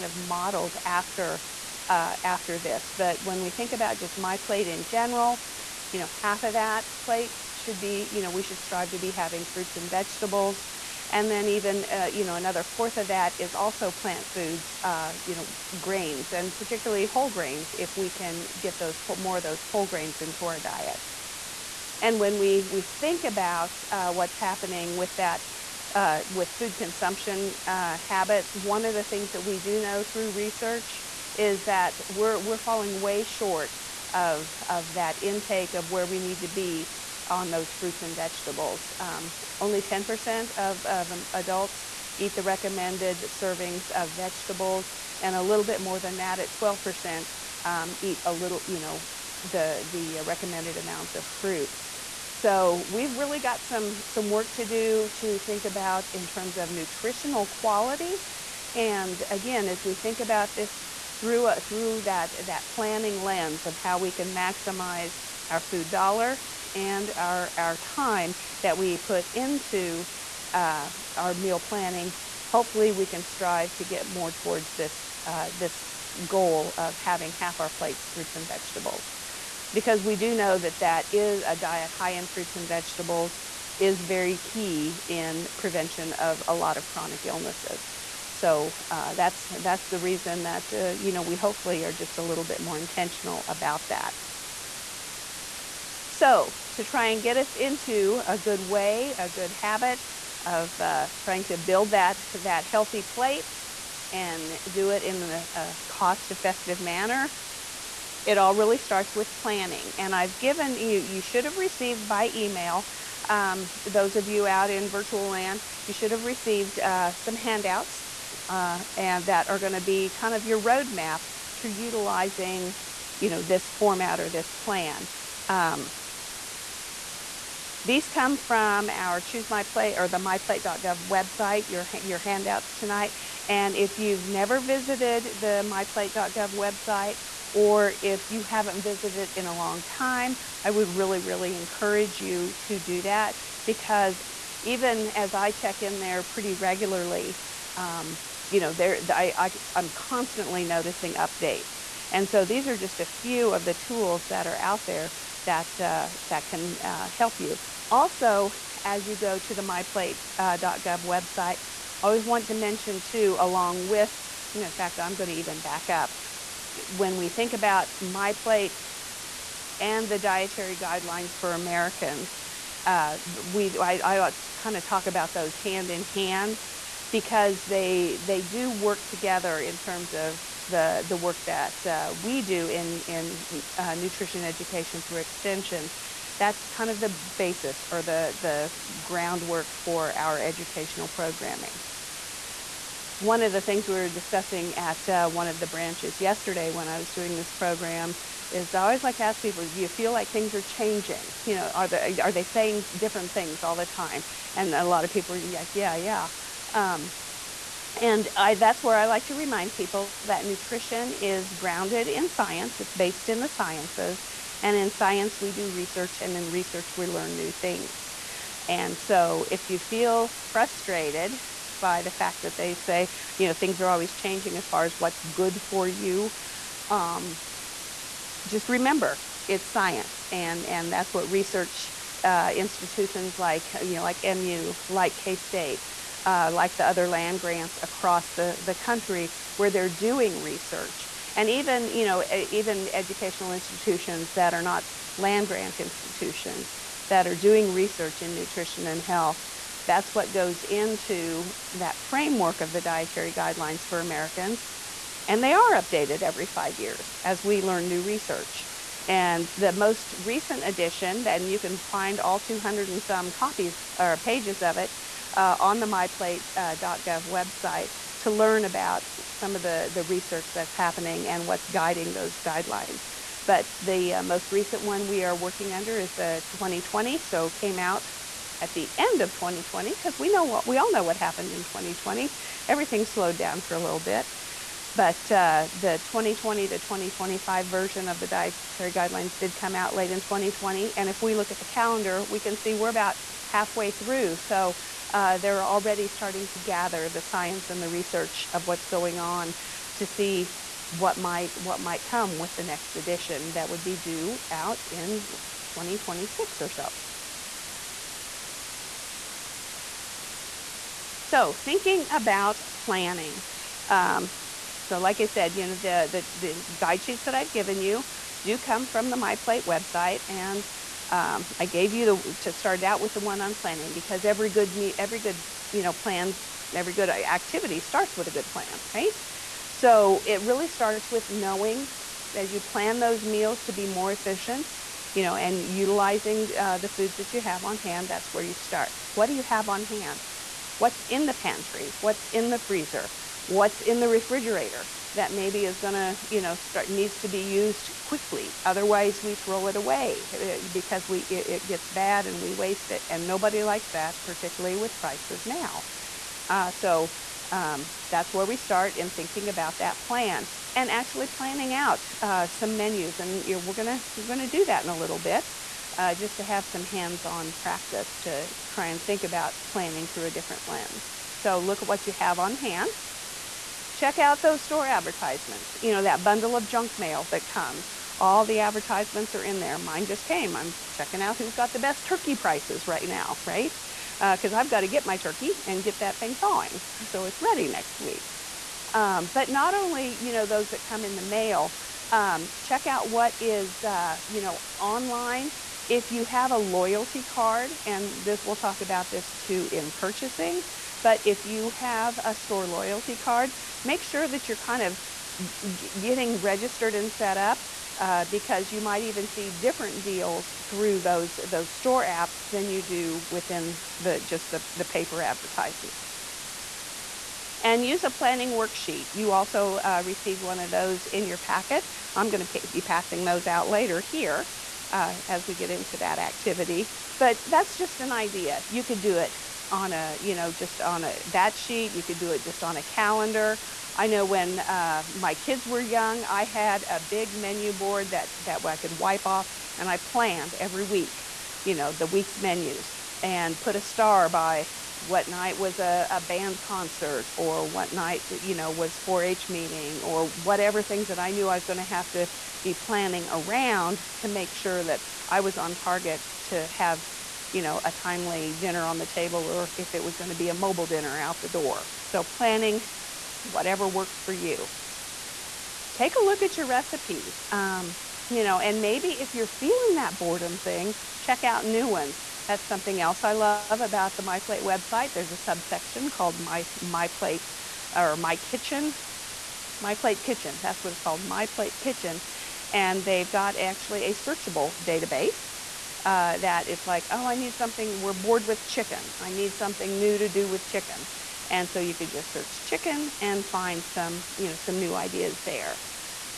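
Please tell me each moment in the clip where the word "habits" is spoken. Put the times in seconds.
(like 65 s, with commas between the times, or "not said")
27 s, 99 s.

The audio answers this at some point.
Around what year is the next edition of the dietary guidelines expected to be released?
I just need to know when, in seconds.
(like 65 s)
305 s.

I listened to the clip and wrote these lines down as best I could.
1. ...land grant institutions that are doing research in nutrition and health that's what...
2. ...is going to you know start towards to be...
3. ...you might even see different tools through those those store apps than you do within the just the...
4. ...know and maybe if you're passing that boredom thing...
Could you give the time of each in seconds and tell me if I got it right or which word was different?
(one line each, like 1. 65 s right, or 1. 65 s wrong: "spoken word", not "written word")
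1. 245 s right
2. 345 s wrong: "needs", not "towards"
3. 408 s wrong: "deals", not "tools"
4. 468 s wrong: "feeling", not "passing".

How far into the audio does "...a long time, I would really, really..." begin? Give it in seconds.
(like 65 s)
139 s.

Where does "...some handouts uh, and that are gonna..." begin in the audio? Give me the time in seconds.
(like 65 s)
117 s.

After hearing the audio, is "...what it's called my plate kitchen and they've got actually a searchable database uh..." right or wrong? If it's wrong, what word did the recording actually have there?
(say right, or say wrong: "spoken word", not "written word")
right.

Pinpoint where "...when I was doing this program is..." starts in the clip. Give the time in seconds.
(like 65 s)
196 s.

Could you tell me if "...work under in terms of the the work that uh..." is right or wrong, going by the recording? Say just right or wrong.
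wrong.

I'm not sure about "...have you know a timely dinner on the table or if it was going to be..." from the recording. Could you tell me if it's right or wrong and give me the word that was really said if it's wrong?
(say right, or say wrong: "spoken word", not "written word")
right.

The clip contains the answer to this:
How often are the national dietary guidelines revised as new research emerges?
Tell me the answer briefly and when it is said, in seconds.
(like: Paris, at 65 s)
every five years, at 256 s.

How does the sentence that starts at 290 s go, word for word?
And if we look at the calendar, we can see we're about halfway through.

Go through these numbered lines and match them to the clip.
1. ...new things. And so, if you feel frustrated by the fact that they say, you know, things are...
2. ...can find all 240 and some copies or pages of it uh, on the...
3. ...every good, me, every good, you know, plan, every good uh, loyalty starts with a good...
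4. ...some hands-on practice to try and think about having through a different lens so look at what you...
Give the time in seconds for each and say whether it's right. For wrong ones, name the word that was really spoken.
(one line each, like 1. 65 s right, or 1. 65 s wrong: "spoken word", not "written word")
1. 217 s right
2. 261 s wrong: "200", not "240"
3. 324 s wrong: "activity", not "loyalty"
4. 366 s wrong: "planning", not "having".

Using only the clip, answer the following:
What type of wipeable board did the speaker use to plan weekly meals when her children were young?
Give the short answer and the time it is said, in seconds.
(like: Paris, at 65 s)
menu board, at 437 s.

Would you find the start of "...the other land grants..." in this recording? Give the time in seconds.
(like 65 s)
236 s.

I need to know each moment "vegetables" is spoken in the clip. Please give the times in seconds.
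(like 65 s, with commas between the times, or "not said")
9 s, 38 s, 44 s, 78 s, 82 s.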